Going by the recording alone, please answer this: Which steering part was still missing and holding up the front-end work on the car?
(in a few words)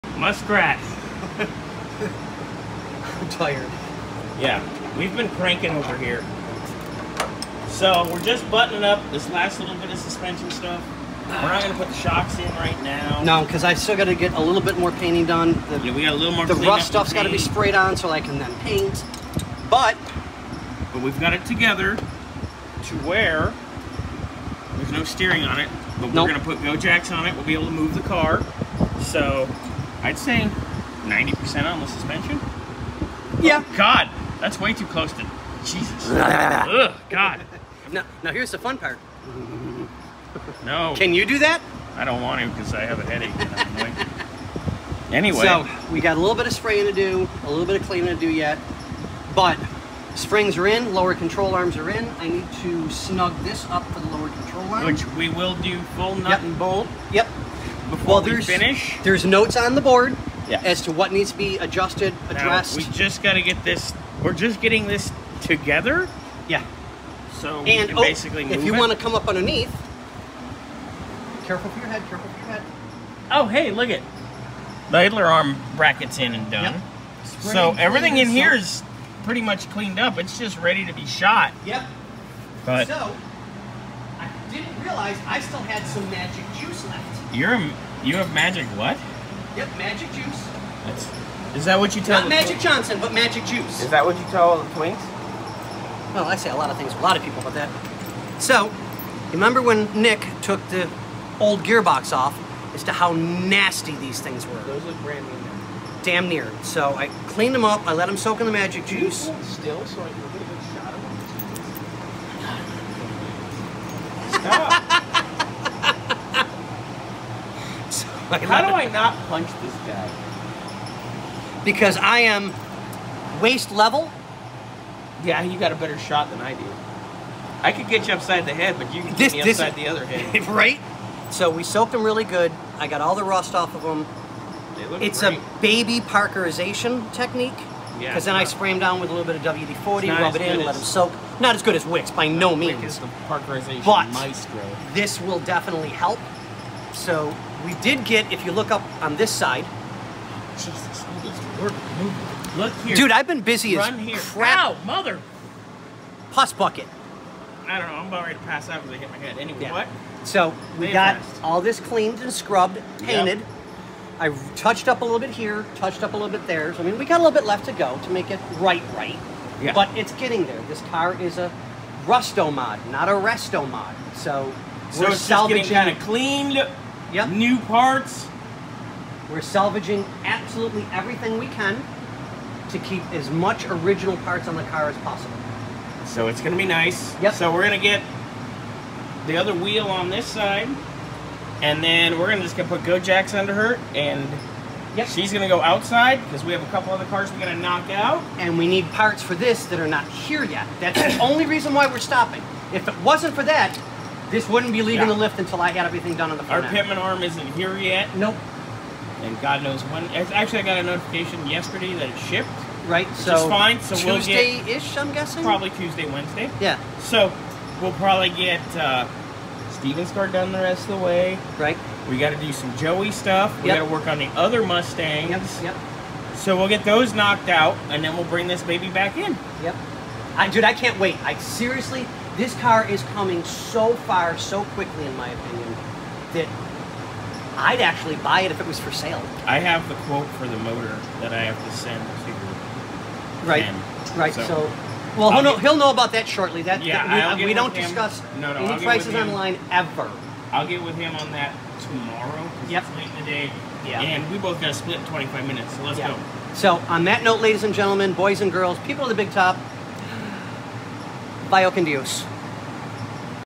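Pitman arm.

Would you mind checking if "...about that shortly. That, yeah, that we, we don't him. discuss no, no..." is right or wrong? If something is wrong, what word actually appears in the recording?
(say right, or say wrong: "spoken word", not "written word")
right.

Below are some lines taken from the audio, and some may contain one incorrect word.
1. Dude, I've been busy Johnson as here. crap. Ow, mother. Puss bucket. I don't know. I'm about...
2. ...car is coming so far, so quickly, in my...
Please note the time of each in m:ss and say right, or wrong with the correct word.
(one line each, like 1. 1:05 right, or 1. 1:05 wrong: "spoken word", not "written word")
1. 2:32 wrong: "Run", not "Johnson"
2. 3:52 right.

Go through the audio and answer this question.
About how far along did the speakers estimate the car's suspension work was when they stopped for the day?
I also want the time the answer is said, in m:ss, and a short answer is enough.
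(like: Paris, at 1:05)
90%, at 0:31.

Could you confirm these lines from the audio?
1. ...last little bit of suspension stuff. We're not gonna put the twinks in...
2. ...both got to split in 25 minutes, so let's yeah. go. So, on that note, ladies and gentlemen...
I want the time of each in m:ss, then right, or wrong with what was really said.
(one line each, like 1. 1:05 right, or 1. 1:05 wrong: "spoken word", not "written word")
1. 0:09 wrong: "shocks", not "twinks"
2. 4:14 right.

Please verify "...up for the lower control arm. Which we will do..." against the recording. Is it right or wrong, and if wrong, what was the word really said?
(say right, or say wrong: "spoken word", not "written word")
right.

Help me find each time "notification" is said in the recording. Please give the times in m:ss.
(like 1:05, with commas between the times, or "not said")
3:30.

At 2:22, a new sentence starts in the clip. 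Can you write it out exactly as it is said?
Wix is the parkerization but this will definitely help.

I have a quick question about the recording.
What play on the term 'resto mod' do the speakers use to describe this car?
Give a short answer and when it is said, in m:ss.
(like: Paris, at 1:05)
Rusto mod, at 2:52.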